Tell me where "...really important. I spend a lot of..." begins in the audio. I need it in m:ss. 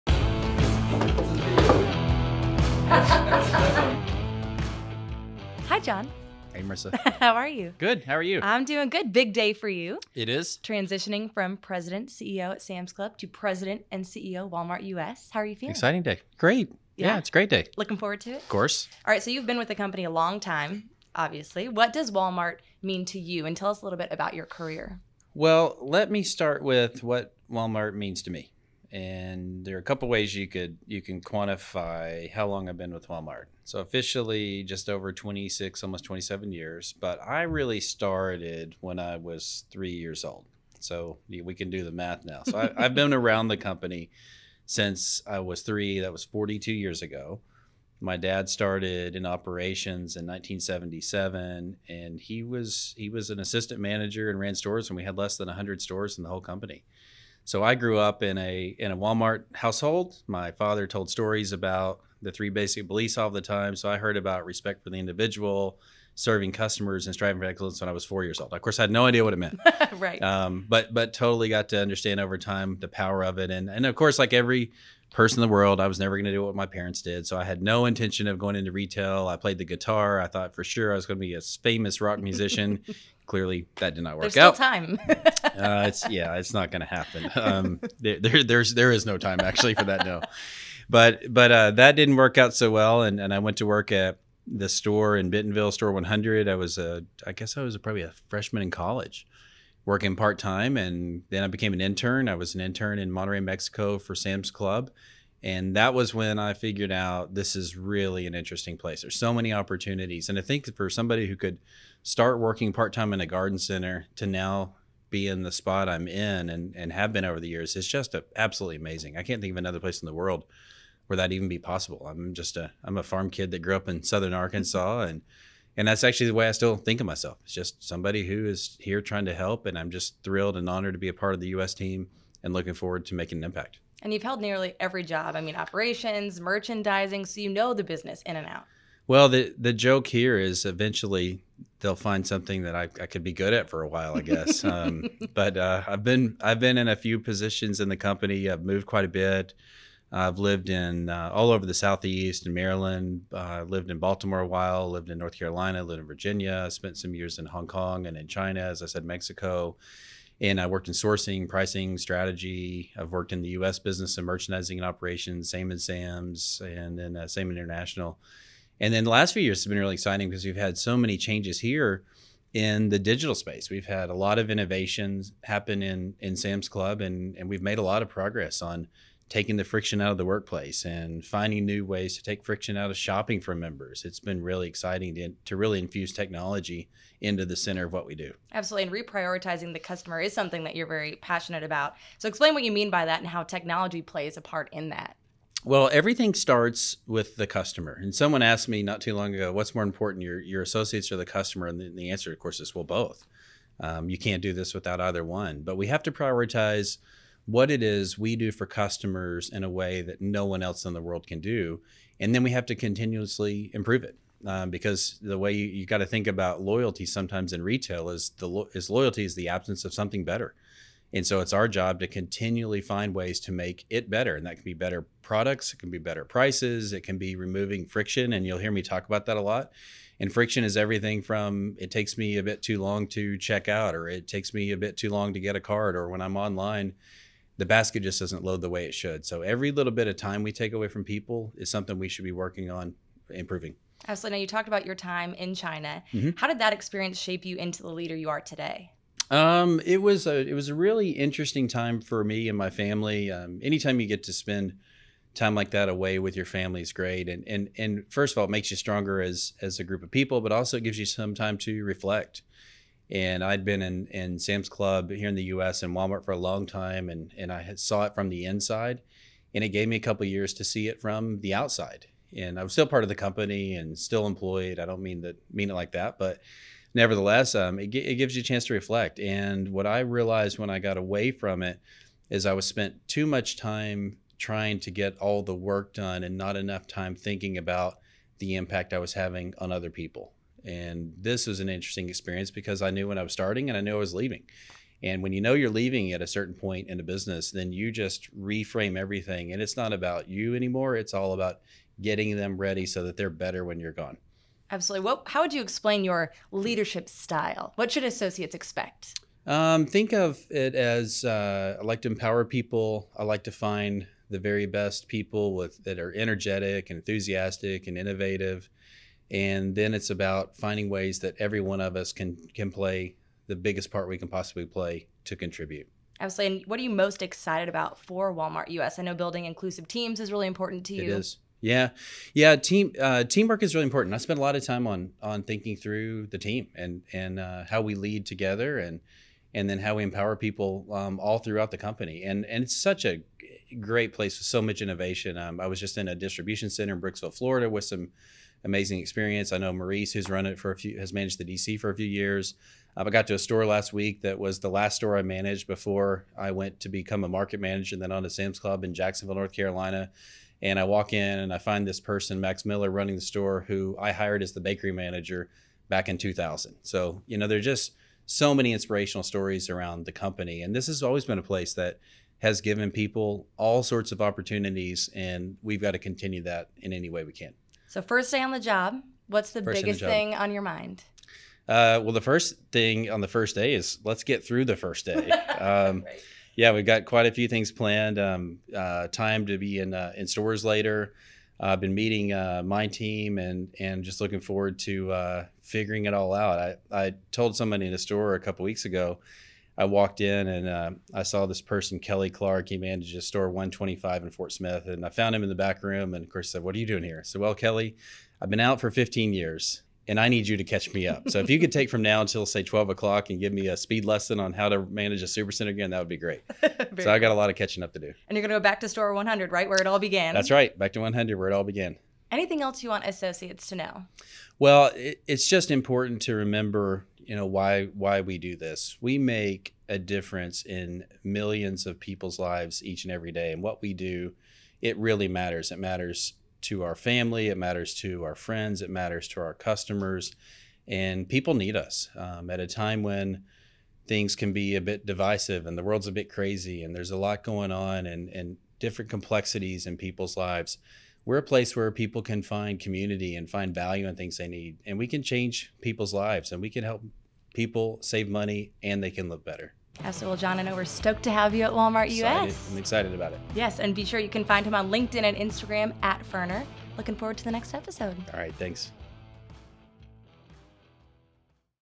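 5:33.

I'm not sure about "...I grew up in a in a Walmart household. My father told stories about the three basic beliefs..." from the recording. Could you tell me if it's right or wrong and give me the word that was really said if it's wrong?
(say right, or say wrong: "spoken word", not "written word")
right.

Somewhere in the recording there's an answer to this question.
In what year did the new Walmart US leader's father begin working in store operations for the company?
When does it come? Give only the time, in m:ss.
0:50.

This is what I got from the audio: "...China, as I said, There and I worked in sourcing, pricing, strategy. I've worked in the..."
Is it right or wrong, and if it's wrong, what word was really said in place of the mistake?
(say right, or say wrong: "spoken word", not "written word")
wrong: "Mexico", not "There".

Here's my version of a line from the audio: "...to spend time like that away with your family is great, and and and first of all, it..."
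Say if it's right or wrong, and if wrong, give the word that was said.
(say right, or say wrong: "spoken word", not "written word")
right.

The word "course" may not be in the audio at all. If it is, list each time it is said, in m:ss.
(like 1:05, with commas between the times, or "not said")
0:18, 1:08, 1:13, 3:22, 6:46.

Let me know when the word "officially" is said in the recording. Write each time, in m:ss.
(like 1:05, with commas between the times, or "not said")
0:33.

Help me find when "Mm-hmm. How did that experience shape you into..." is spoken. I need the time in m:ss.
4:06.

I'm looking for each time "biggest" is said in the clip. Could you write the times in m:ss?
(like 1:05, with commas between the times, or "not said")
5:23, 6:19.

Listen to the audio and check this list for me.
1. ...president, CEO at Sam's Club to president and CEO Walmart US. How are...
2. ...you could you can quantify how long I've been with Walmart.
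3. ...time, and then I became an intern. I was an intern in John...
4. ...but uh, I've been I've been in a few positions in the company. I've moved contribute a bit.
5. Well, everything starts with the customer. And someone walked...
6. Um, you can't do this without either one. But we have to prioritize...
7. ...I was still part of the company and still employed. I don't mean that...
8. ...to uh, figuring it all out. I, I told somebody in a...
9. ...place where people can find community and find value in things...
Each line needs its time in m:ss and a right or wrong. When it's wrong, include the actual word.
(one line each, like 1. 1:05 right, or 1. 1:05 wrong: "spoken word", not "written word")
1. 0:11 right
2. 0:30 right
3. 1:40 wrong: "Monterrey", not "John"
4. 2:25 wrong: "quite", not "contribute"
5. 3:15 wrong: "asked", not "walked"
6. 3:23 right
7. 4:32 right
8. 6:34 right
9. 7:31 right.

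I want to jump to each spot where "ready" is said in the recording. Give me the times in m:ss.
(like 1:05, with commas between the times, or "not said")
5:02.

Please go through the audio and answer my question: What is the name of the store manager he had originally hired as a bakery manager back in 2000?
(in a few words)
Max Miller.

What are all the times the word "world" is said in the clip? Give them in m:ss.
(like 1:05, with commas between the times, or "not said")
1:15, 2:00, 3:31, 7:25.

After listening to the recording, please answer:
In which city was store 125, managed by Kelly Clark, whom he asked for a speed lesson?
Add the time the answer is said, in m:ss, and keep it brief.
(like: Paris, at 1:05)
Fort Smith, at 6:44.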